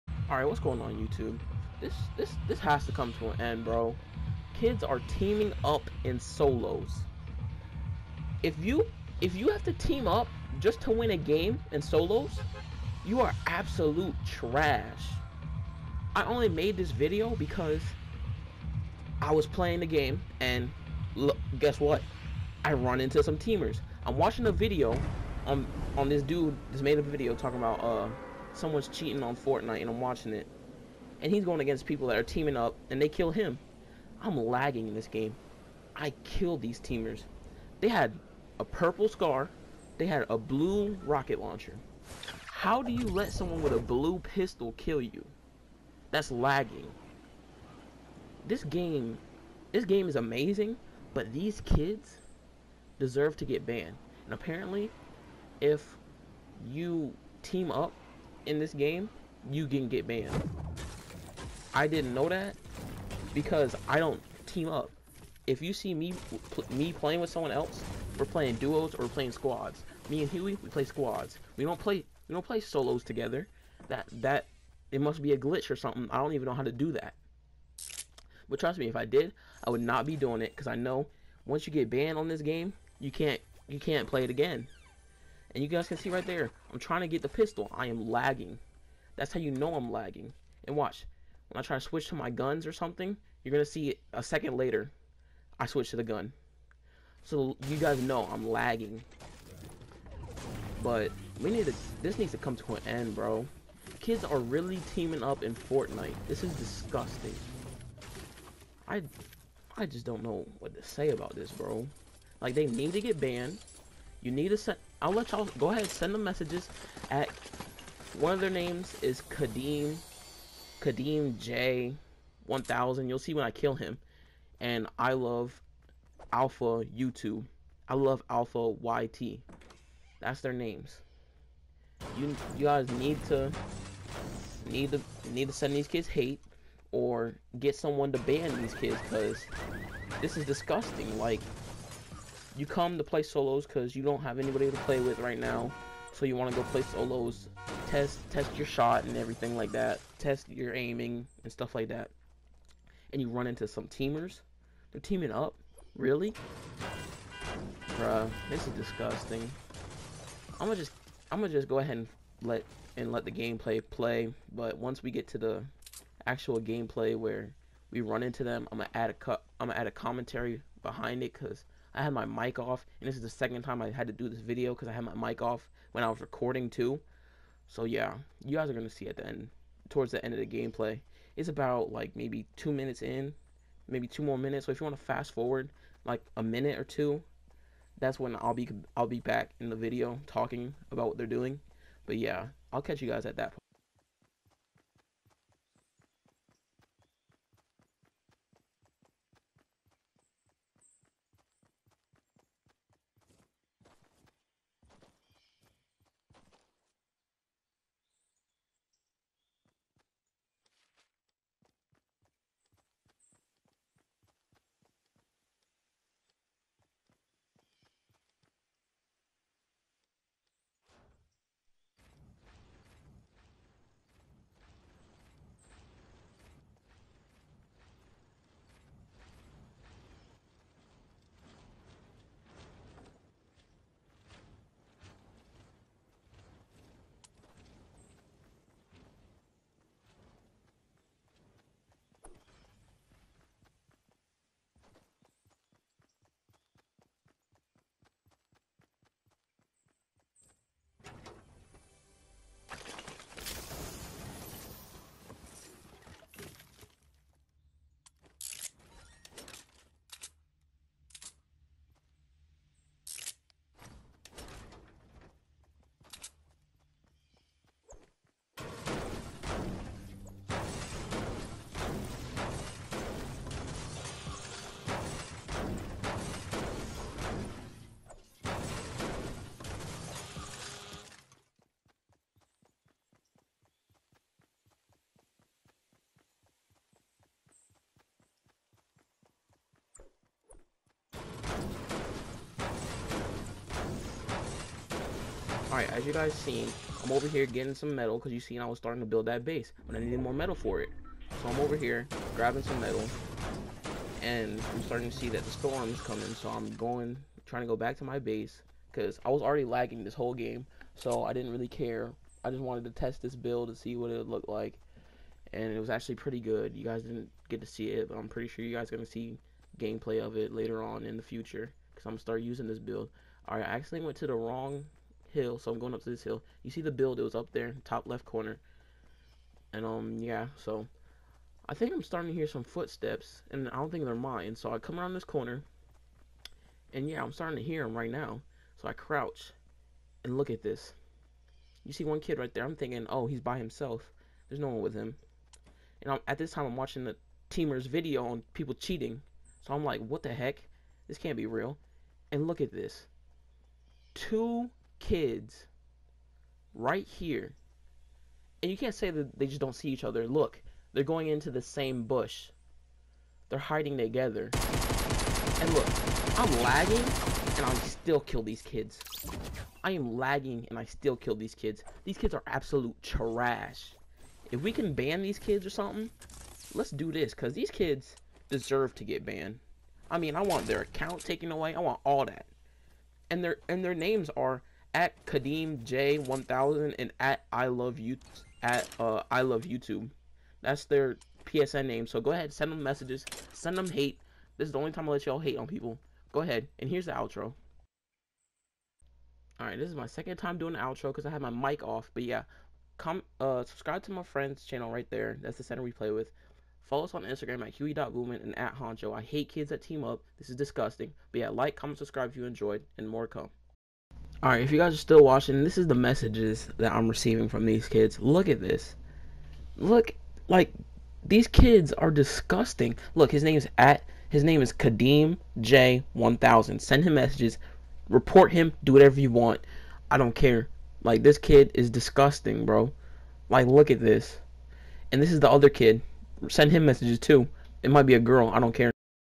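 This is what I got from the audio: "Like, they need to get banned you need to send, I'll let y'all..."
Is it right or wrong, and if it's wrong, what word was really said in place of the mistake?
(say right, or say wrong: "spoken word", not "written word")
right.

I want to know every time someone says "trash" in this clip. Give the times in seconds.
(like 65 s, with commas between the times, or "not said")
14 s, 373 s.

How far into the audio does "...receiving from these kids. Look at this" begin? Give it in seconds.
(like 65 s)
417 s.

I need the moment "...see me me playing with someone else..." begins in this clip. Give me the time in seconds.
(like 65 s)
65 s.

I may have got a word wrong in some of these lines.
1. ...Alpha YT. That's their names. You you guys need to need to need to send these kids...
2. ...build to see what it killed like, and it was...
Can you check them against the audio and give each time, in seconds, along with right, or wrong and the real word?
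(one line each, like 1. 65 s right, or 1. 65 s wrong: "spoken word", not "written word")
1. 128 s right
2. 313 s wrong: "looked", not "killed".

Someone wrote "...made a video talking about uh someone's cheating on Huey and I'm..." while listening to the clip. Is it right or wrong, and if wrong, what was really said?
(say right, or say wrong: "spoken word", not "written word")
wrong: "Fortnite", not "Huey".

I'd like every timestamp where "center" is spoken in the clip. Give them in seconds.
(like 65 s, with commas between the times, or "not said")
405 s.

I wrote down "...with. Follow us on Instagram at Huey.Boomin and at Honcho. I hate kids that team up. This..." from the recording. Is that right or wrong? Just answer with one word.
right.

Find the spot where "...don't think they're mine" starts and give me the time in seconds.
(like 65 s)
333 s.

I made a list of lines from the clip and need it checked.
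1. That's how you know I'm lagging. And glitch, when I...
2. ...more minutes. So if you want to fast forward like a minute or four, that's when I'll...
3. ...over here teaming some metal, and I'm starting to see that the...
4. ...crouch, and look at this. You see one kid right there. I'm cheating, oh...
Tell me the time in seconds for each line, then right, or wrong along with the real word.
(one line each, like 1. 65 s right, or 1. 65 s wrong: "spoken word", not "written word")
1. 89 s wrong: "watch", not "glitch"
2. 184 s wrong: "two", not "four"
3. 301 s wrong: "grabbing", not "teaming"
4. 338 s wrong: "thinking", not "cheating".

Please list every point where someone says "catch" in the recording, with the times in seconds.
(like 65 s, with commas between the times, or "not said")
192 s.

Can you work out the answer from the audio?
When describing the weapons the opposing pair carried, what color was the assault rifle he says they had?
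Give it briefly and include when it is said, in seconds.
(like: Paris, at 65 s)
purple, at 38 s.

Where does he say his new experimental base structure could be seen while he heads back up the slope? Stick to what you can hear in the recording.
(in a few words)
top left corner.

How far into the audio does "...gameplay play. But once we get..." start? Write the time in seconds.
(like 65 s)
163 s.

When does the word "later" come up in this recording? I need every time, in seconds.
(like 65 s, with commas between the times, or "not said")
94 s, 320 s.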